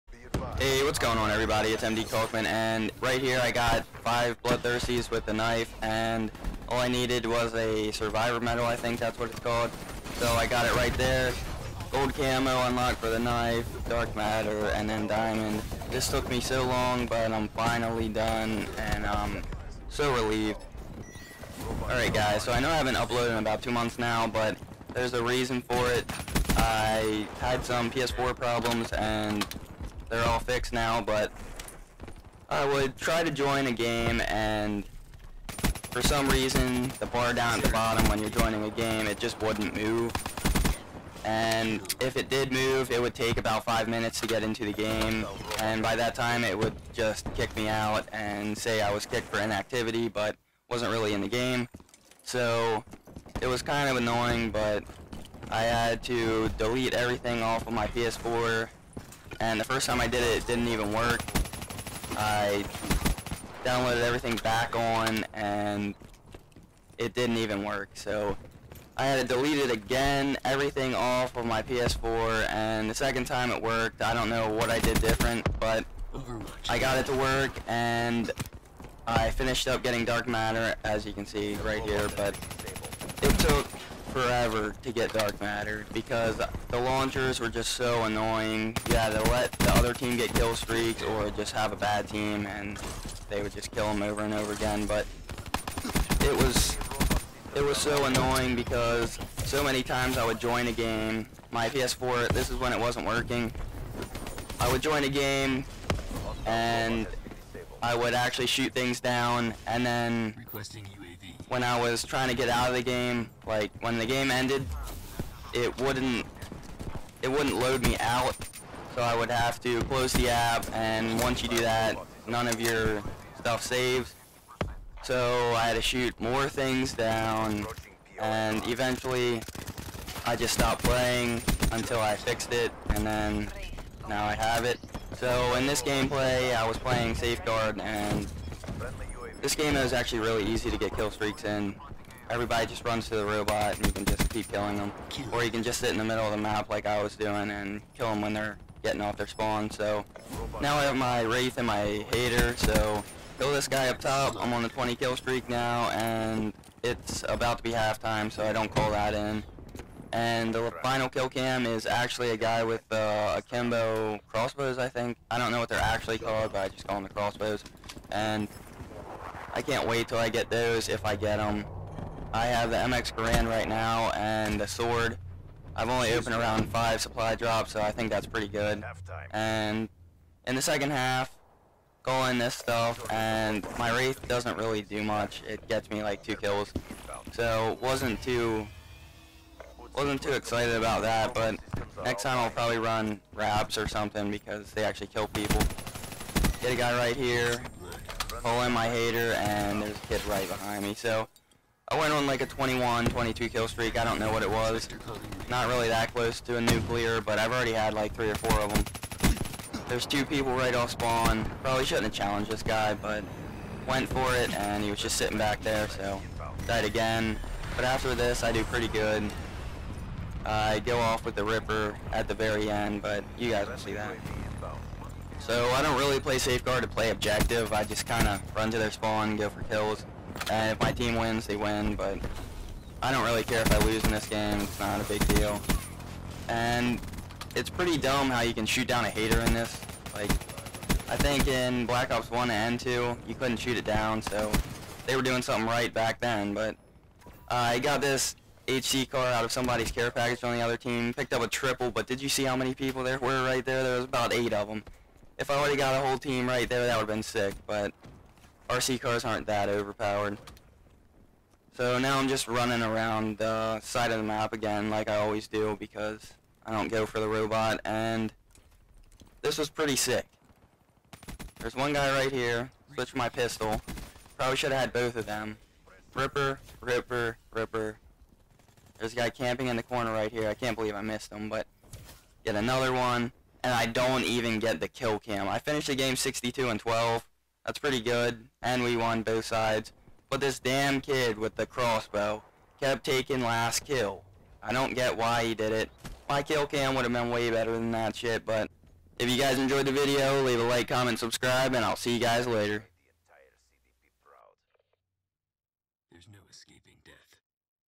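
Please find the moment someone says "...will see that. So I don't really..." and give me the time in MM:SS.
03:43.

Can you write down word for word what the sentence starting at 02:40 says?
And the final kill cam is actually a guy with uh, a Kimbo crossbows, I think.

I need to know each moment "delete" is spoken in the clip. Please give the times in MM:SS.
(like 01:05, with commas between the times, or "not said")
00:56, 01:09.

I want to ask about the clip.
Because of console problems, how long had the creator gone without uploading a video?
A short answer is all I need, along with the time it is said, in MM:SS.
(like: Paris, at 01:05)
about two months, at 00:23.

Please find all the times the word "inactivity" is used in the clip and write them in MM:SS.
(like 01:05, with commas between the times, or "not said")
00:49.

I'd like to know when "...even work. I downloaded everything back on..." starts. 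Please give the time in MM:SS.
01:00.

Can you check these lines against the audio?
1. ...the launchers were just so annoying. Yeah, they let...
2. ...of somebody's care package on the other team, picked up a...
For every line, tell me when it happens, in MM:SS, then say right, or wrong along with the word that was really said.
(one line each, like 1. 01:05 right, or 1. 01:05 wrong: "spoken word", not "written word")
1. 01:26 right
2. 04:09 right.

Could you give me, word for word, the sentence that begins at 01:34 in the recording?
But it was it was so annoying because so many times I would join a game.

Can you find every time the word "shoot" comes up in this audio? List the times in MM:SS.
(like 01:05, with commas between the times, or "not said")
01:48, 02:05, 03:58, 04:03.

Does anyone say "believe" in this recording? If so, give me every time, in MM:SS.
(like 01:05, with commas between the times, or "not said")
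04:40.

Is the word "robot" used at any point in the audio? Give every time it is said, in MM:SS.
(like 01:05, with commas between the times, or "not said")
02:23, 04:27.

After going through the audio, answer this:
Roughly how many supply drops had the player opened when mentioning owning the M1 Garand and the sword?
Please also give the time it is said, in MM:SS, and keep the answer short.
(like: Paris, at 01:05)
5, at 02:56.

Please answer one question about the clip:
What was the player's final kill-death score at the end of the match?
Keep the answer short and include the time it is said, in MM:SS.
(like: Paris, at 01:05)
62 and 12, at 04:46.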